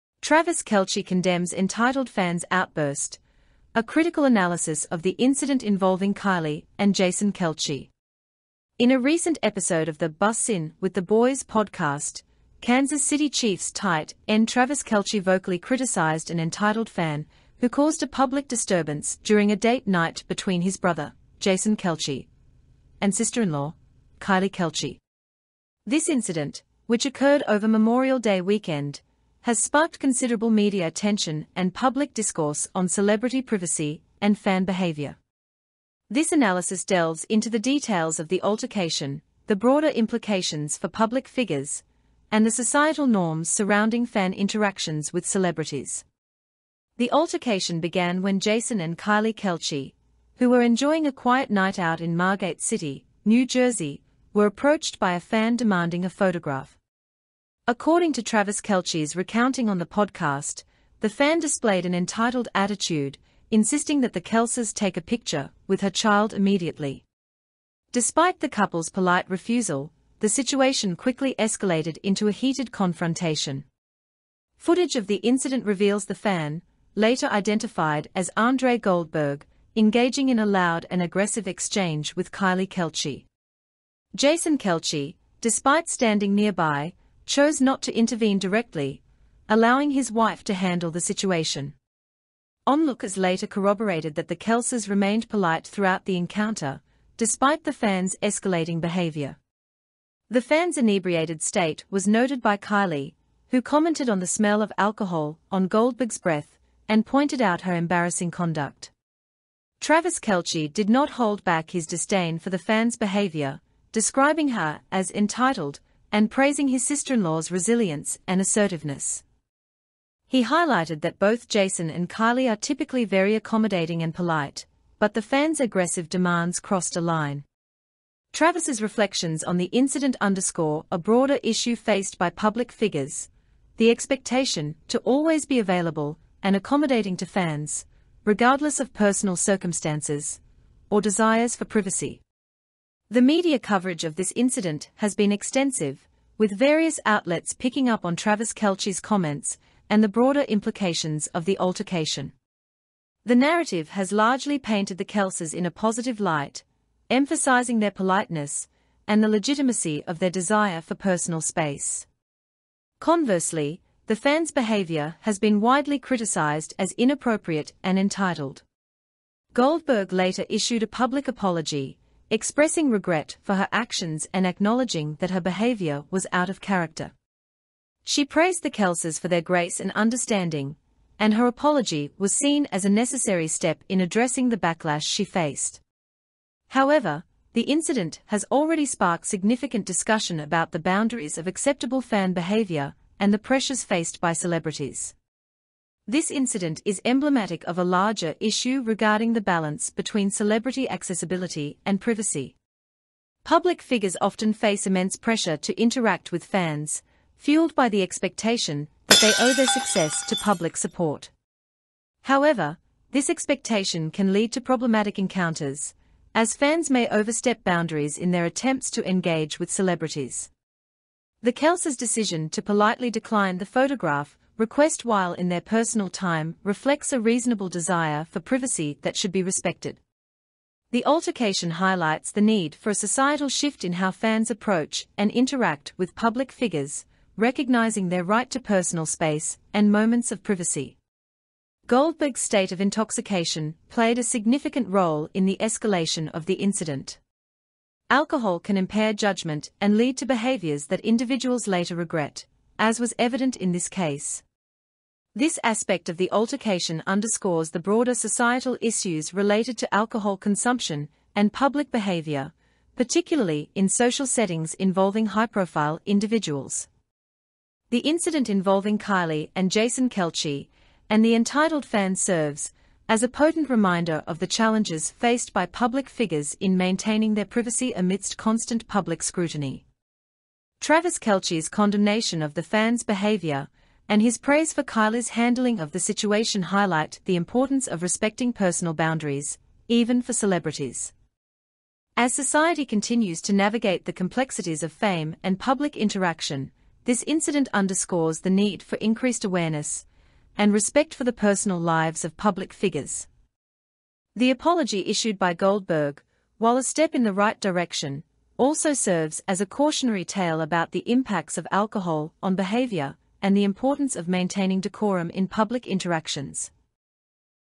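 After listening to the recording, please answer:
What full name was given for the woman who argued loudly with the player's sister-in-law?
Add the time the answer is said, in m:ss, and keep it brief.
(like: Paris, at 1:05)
Andre Goldberg, at 1:18.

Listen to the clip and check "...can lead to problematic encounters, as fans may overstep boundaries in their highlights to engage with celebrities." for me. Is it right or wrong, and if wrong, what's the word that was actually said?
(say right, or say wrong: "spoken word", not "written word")
wrong: "attempts", not "highlights".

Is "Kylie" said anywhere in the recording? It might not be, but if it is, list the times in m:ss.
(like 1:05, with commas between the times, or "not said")
0:06, 0:24, 0:48, 1:22, 1:42, 2:02, 4:28, 4:44.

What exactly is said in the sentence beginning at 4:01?
Goldberg's state of intoxication played a significant role in the escalation of the incident.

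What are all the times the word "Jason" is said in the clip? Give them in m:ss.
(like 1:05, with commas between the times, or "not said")
0:06, 0:21, 0:48, 1:24, 2:01, 4:29.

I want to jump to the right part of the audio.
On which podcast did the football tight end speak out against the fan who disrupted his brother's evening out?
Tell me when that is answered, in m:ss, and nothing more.
0:10.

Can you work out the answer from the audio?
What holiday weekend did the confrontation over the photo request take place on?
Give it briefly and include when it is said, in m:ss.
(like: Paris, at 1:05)
Memorial Day weekend, at 0:27.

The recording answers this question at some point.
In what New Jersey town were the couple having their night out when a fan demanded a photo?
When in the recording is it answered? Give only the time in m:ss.
0:52.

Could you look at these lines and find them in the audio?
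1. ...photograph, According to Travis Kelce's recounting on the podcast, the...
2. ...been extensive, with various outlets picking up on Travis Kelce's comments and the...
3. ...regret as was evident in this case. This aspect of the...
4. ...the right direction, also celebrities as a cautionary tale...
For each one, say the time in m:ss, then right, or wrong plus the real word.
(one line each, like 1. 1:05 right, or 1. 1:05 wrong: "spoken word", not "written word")
1. 0:56 right
2. 2:25 right
3. 4:11 right
4. 5:07 wrong: "serves", not "celebrities".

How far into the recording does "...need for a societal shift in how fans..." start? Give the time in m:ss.
3:52.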